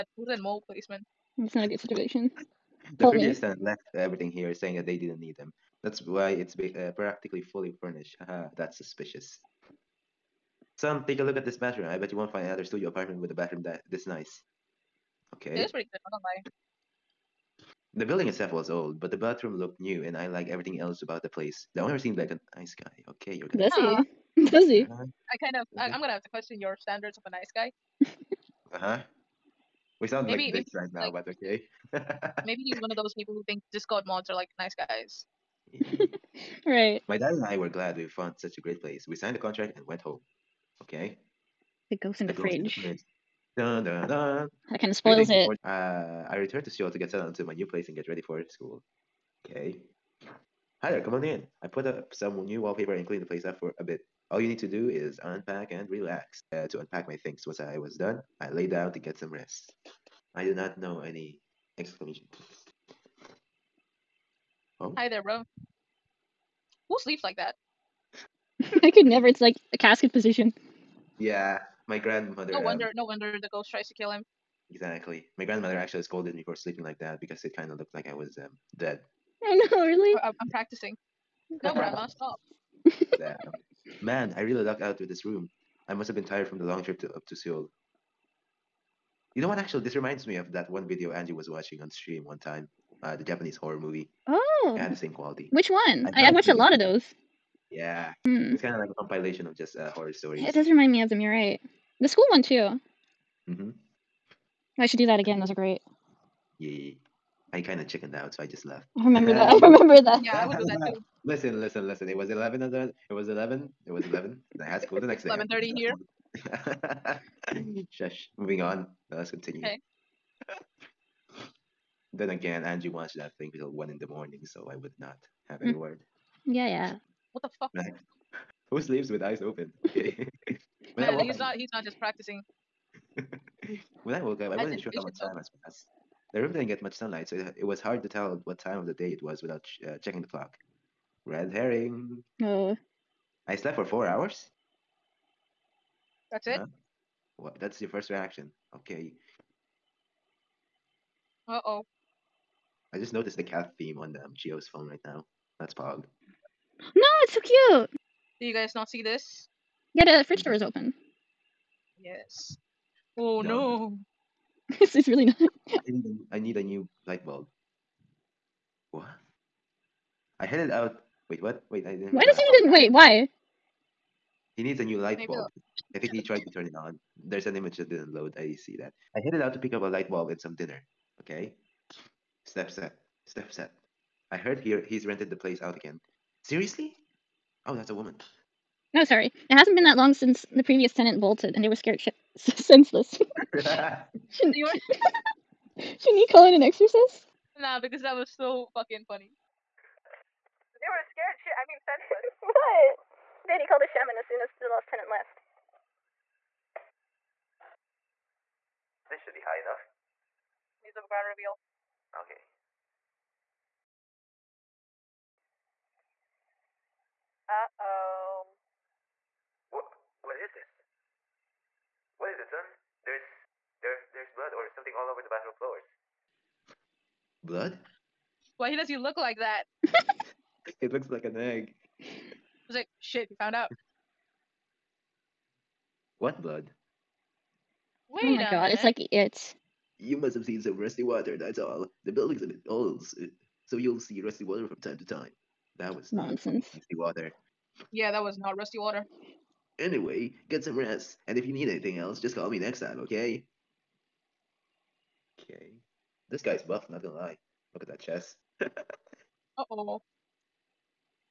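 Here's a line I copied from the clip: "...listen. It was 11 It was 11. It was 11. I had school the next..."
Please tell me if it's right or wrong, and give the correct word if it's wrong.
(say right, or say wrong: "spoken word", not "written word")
right.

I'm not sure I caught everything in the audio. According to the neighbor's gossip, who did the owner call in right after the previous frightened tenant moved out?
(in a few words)
A shaman.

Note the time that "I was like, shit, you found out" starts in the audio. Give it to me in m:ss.
3:52.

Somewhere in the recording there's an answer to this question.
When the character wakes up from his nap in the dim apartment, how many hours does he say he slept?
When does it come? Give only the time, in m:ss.
2:23.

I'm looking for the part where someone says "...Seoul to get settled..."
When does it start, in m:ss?
0:46.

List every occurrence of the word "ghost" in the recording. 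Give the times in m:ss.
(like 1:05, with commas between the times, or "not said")
0:42, 1:13.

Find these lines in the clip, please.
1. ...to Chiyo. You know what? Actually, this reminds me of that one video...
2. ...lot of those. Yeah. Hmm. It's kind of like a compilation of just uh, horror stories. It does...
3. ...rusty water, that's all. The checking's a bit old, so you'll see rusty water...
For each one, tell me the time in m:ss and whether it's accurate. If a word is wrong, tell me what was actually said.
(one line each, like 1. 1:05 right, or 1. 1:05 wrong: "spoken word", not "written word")
1. 1:27 wrong: "Seoul", not "Chiyo"
2. 1:36 right
3. 4:00 wrong: "building", not "checking".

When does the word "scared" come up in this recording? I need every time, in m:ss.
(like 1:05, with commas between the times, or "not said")
3:11, 3:21.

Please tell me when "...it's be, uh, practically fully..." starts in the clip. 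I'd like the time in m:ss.
0:06.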